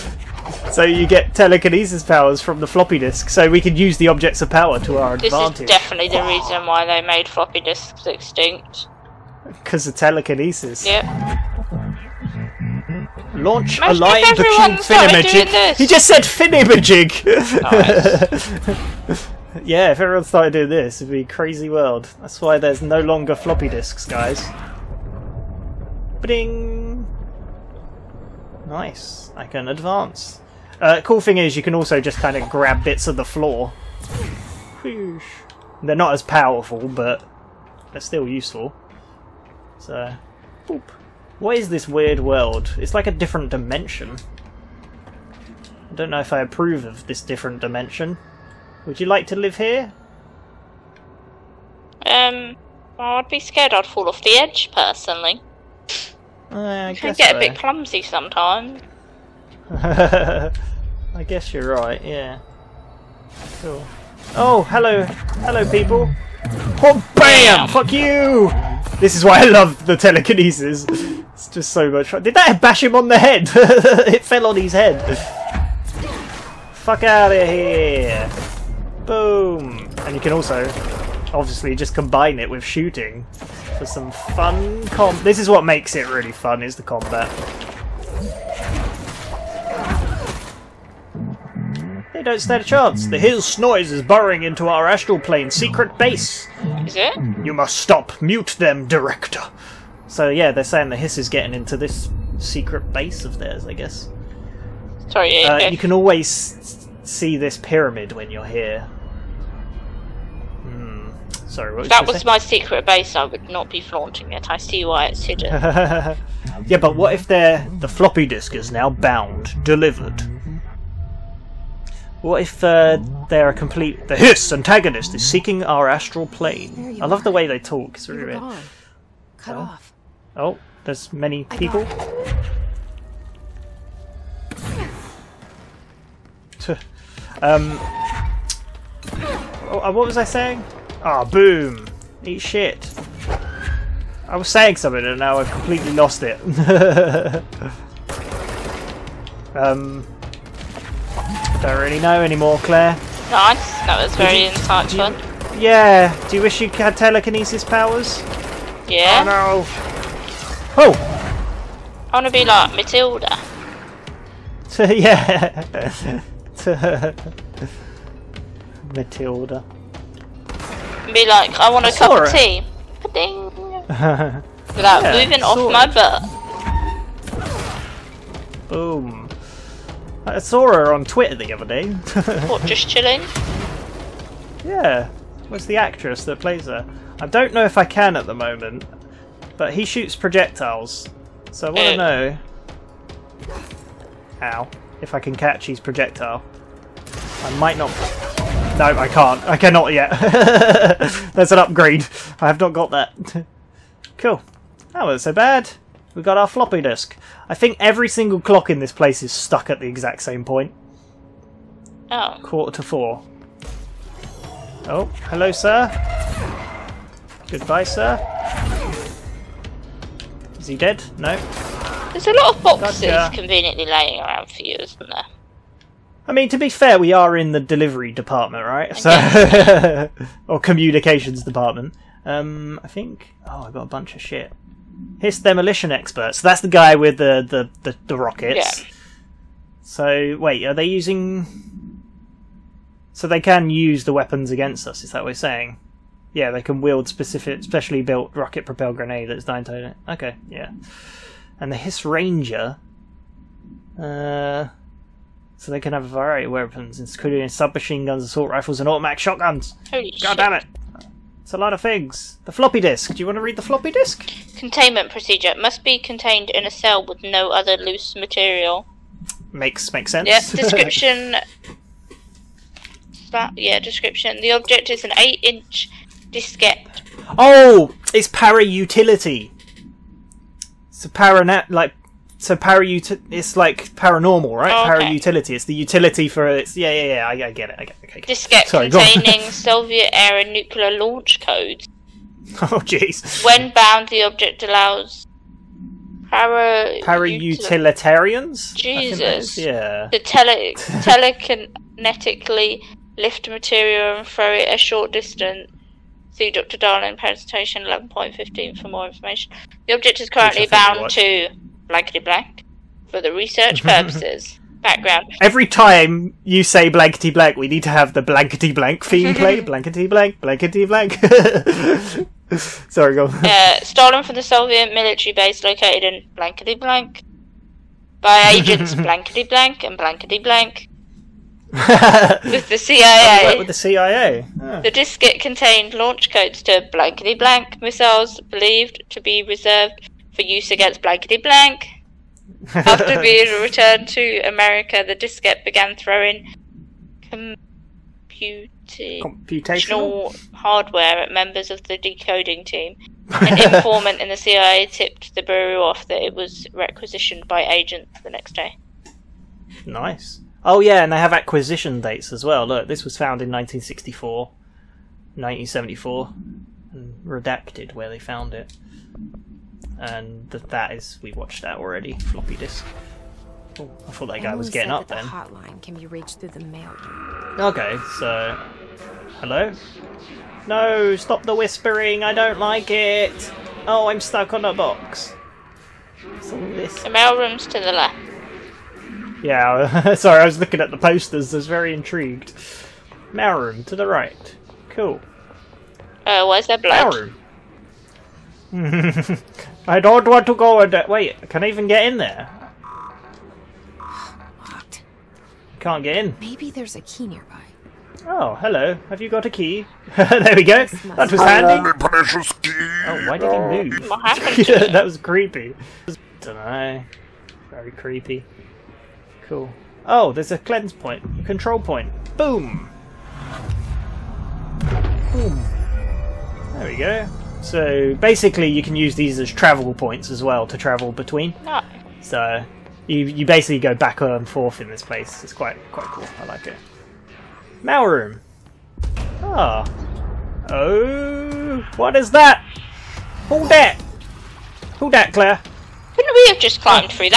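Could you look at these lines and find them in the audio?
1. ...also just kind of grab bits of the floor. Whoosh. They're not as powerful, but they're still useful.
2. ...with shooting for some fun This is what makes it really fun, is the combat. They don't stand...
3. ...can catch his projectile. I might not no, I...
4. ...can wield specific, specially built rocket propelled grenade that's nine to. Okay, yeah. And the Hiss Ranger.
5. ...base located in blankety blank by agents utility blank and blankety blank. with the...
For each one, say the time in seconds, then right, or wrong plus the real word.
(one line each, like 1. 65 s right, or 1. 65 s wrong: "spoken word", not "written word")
1. 31 s right
2. 82 s right
3. 195 s right
4. 246 s right
5. 325 s wrong: "blankety", not "utility".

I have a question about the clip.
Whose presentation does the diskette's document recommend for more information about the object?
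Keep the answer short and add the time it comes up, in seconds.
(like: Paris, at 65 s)
Dr. Darling, at 306 s.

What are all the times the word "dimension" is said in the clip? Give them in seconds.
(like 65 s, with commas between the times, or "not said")
43 s, 47 s.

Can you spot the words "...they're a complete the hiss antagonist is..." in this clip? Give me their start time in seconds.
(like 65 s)
123 s.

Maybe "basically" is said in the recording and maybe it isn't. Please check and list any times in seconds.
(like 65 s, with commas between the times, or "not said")
428 s, 433 s.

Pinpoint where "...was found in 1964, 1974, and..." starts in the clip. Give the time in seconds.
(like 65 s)
363 s.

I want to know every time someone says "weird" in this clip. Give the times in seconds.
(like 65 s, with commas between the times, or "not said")
41 s, 128 s.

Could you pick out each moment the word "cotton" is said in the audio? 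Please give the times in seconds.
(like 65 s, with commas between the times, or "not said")
not said.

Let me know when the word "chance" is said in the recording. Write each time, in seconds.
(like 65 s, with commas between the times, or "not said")
92 s.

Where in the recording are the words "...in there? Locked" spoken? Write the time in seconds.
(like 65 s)
402 s.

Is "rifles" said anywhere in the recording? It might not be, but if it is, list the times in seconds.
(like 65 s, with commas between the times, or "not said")
258 s.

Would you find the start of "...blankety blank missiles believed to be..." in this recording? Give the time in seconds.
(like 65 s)
336 s.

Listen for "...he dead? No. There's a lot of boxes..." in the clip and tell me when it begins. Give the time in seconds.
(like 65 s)
220 s.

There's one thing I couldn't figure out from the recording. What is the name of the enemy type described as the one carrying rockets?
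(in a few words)
Hiss demolition expert.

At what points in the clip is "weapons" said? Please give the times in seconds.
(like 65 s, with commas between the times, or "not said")
244 s, 256 s.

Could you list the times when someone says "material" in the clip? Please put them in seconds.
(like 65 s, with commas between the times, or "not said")
268 s, 303 s.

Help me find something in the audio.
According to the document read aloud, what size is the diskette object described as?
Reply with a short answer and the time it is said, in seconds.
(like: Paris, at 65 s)
Eight-inch, at 275 s.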